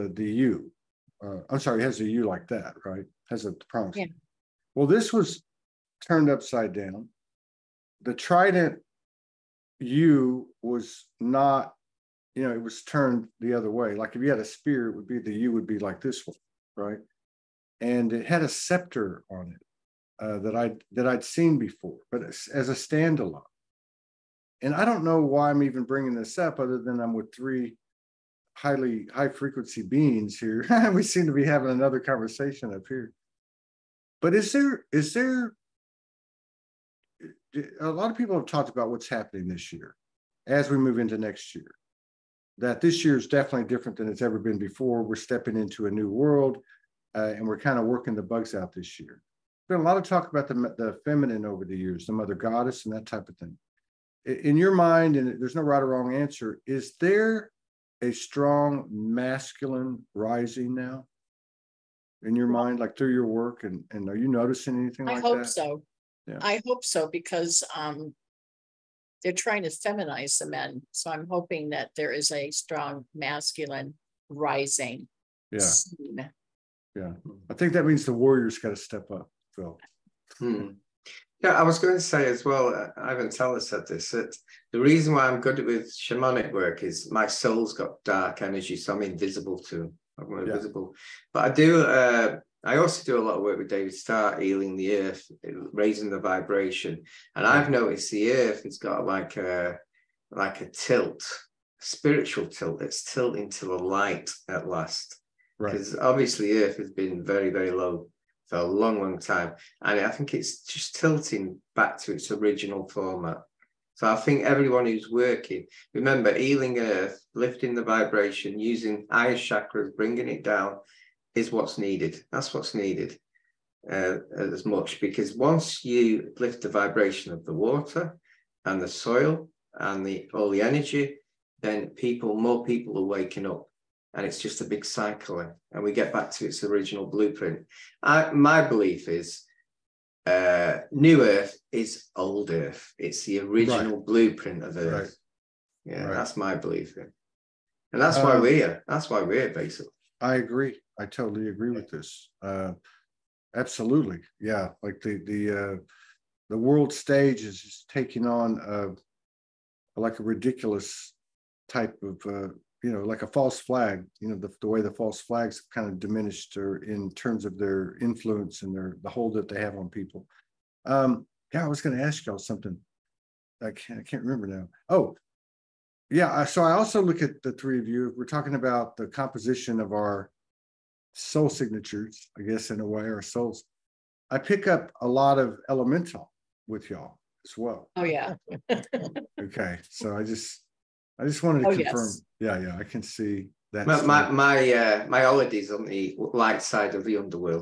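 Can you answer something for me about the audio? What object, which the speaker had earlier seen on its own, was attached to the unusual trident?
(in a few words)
scepter.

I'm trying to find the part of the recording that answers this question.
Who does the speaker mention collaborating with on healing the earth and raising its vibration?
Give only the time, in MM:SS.
01:33.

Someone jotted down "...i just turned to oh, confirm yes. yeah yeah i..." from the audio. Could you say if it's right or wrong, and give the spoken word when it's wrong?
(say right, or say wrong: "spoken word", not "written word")
wrong: "wanted", not "turned".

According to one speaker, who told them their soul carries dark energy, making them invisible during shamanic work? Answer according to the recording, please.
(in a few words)
Ivan Teller.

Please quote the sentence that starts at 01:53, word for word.
So I think everyone who's working, remember healing earth, lifting the vibration, using higher chakras, bringing it down, is what's needed.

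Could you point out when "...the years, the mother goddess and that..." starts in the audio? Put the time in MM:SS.
00:51.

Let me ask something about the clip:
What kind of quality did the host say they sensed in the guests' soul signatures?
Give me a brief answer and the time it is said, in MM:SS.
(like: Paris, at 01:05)
elemental, at 03:05.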